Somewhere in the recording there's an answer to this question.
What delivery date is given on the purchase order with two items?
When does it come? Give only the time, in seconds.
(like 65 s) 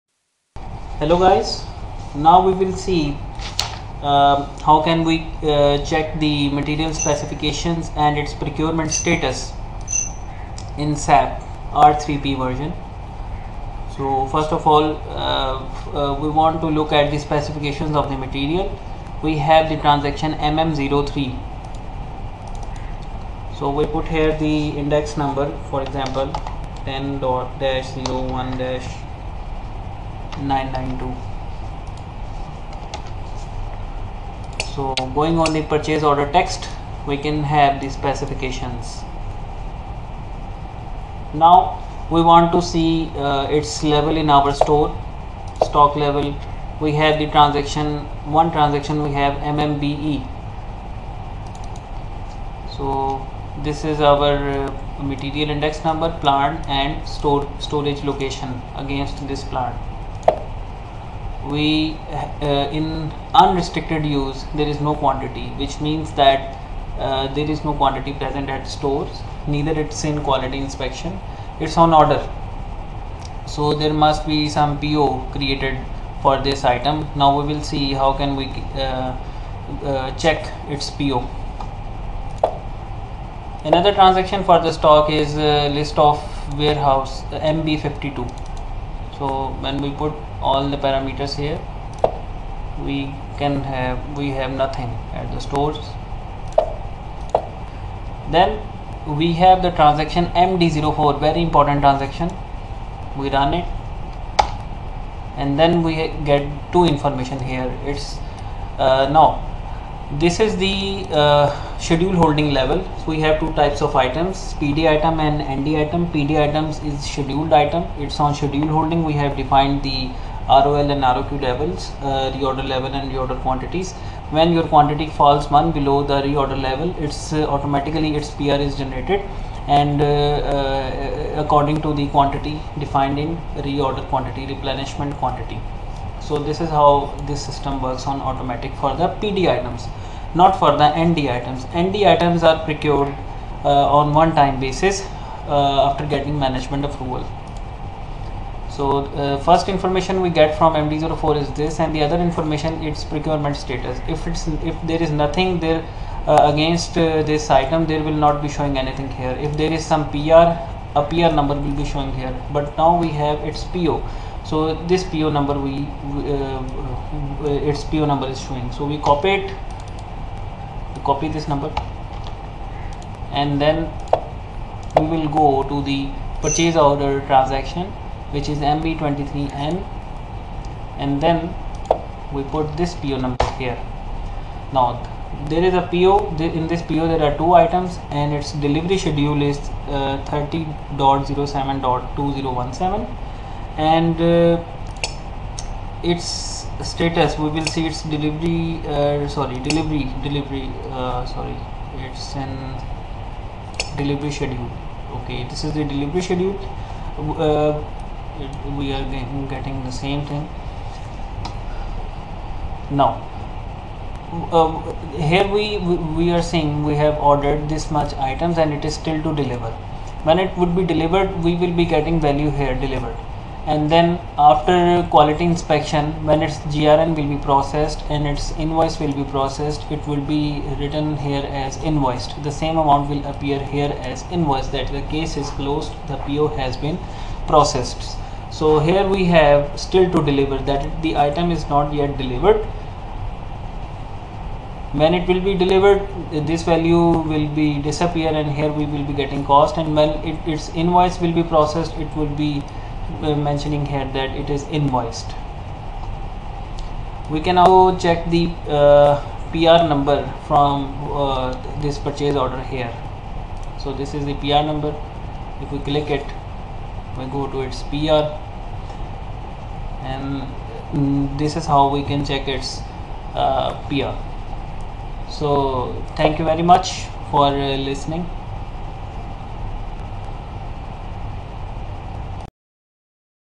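190 s.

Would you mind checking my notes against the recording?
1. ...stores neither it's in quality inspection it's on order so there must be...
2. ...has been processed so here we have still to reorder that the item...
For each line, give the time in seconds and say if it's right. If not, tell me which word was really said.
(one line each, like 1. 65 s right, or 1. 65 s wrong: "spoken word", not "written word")
1. 68 s right
2. 236 s wrong: "deliver", not "reorder".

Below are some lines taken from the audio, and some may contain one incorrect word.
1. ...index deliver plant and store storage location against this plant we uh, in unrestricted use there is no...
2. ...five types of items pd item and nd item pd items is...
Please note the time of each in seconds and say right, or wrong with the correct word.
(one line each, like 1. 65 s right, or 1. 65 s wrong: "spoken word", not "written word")
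1. 55 s wrong: "number", not "deliver"
2. 113 s wrong: "two", not "five".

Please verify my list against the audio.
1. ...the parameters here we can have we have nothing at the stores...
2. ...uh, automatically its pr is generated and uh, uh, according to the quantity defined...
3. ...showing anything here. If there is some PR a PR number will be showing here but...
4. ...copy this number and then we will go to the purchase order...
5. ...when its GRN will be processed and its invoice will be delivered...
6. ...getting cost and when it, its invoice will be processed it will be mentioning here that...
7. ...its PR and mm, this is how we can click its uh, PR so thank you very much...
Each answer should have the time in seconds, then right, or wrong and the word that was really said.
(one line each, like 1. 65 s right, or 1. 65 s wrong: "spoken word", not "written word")
1. 90 s right
2. 127 s right
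3. 158 s right
4. 171 s right
5. 226 s wrong: "processed", not "delivered"
6. 249 s right
7. 267 s wrong: "check", not "click".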